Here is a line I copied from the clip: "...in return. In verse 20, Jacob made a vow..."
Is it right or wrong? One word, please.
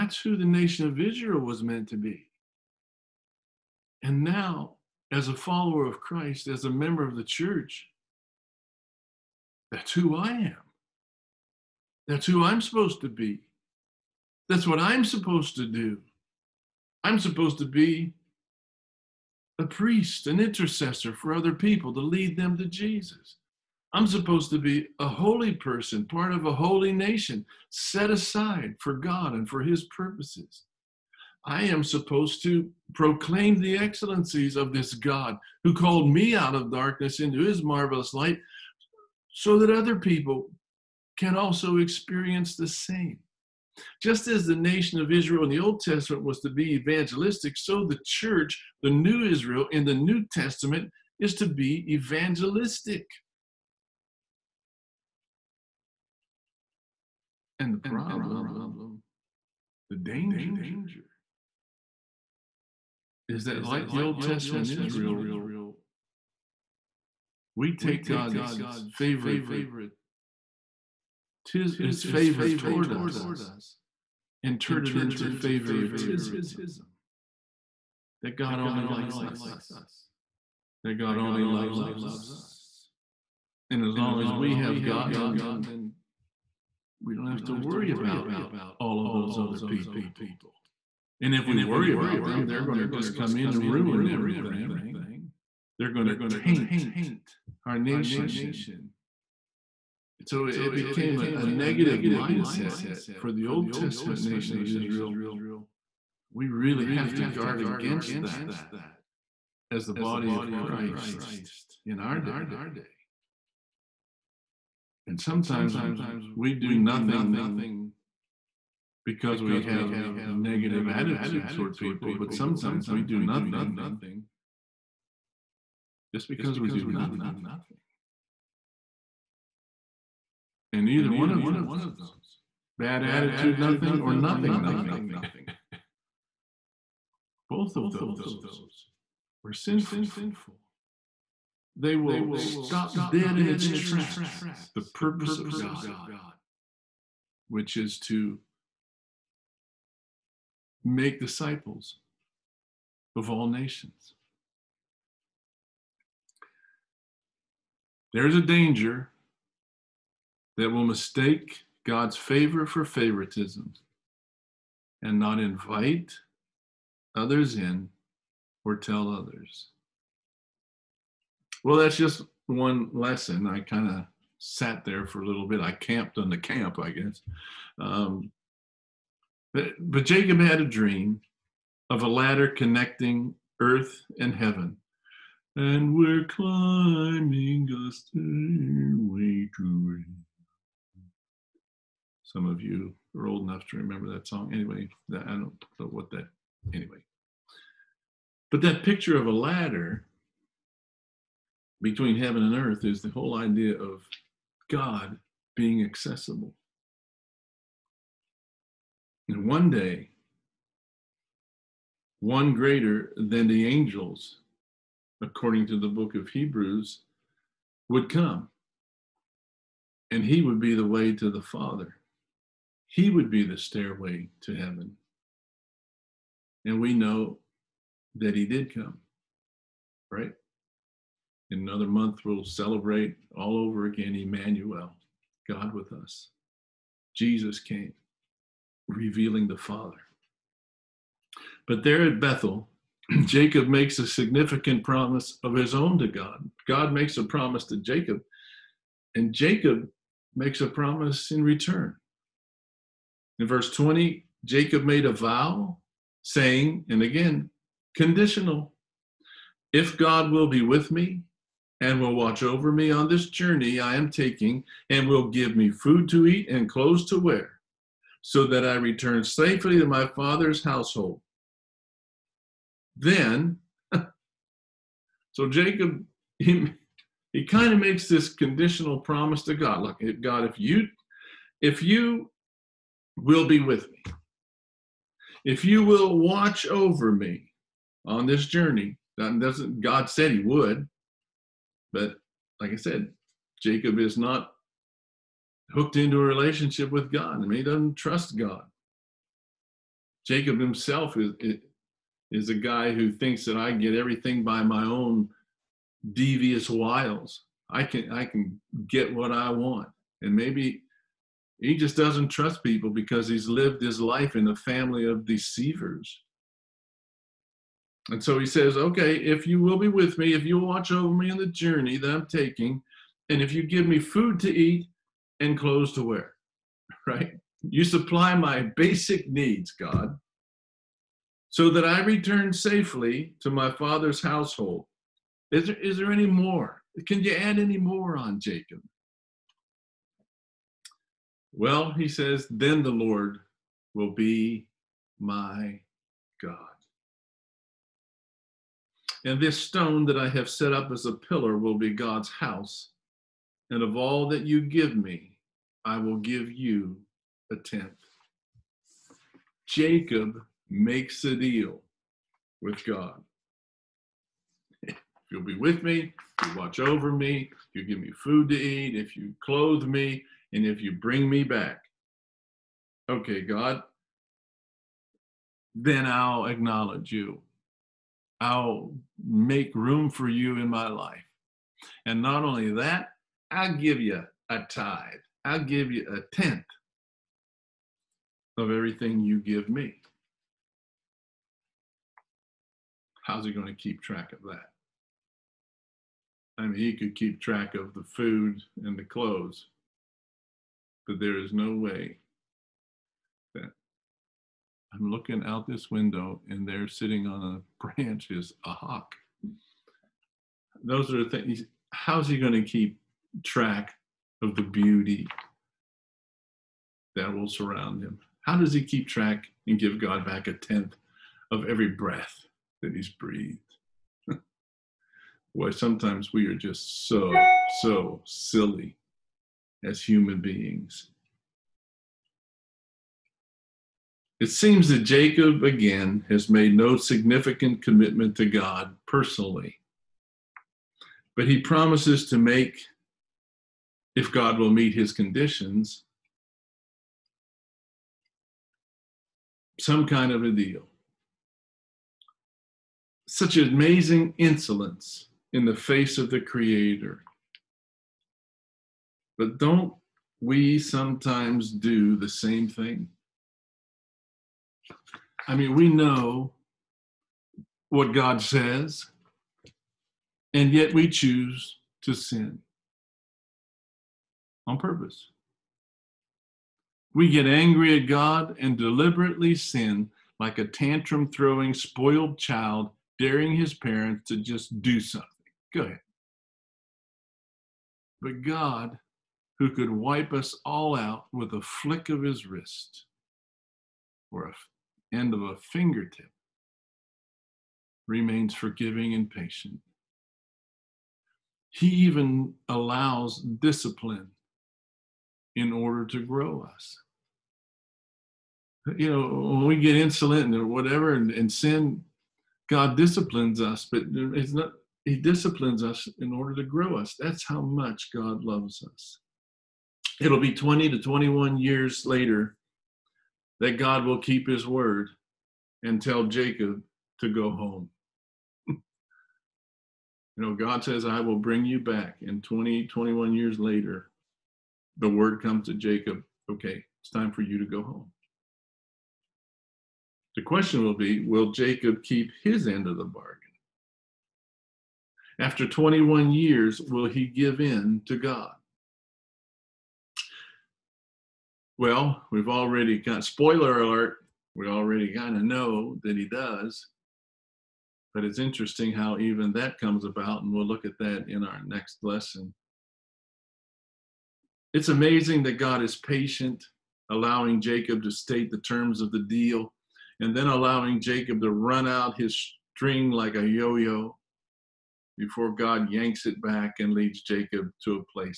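right.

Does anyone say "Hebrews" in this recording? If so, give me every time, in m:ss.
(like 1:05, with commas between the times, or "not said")
3:36.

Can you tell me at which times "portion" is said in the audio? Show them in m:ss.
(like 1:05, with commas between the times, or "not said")
not said.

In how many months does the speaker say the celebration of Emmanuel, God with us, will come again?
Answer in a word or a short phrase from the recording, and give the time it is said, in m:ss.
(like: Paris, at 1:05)
1, at 3:51.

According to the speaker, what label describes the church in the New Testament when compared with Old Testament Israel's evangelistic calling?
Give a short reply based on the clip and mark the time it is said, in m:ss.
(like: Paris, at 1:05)
the new Israel, at 0:48.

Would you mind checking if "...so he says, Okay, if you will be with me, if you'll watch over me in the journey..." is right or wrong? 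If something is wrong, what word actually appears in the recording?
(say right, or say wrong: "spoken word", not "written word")
right.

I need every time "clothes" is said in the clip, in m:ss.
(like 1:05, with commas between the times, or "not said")
4:26, 5:25, 6:09, 6:39.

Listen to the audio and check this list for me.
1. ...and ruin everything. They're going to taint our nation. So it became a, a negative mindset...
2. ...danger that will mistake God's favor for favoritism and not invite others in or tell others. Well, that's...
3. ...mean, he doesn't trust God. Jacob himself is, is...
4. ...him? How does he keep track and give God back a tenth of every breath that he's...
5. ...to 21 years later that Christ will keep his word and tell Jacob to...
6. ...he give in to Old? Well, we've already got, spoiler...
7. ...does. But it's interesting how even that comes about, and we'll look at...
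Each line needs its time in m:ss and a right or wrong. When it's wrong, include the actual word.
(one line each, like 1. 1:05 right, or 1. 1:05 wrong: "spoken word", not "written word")
1. 1:33 right
2. 2:38 right
3. 4:57 right
4. 6:58 right
5. 8:40 wrong: "God", not "Christ"
6. 9:07 wrong: "God", not "Old"
7. 9:16 right.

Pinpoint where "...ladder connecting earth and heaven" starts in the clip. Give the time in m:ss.
3:02.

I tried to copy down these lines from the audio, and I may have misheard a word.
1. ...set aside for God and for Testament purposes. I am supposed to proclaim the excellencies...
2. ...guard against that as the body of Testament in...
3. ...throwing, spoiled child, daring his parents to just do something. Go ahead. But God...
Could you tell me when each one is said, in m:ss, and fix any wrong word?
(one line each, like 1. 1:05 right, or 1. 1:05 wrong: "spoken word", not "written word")
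1. 0:27 wrong: "His", not "Testament"
2. 1:47 wrong: "Christ", not "Testament"
3. 8:01 right.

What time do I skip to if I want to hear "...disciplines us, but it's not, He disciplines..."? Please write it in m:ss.
8:32.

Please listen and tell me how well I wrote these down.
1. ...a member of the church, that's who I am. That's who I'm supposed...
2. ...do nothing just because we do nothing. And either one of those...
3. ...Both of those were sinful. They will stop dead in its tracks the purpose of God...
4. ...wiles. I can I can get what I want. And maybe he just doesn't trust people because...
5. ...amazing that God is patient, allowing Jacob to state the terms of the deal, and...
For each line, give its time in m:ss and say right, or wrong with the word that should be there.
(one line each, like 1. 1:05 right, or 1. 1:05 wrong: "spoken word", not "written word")
1. 0:06 right
2. 2:03 right
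3. 2:17 right
4. 5:06 right
5. 9:24 right.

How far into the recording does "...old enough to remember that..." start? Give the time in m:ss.
3:13.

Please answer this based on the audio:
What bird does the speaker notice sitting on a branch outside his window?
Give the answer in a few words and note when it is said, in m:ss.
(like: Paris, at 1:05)
hawk, at 6:48.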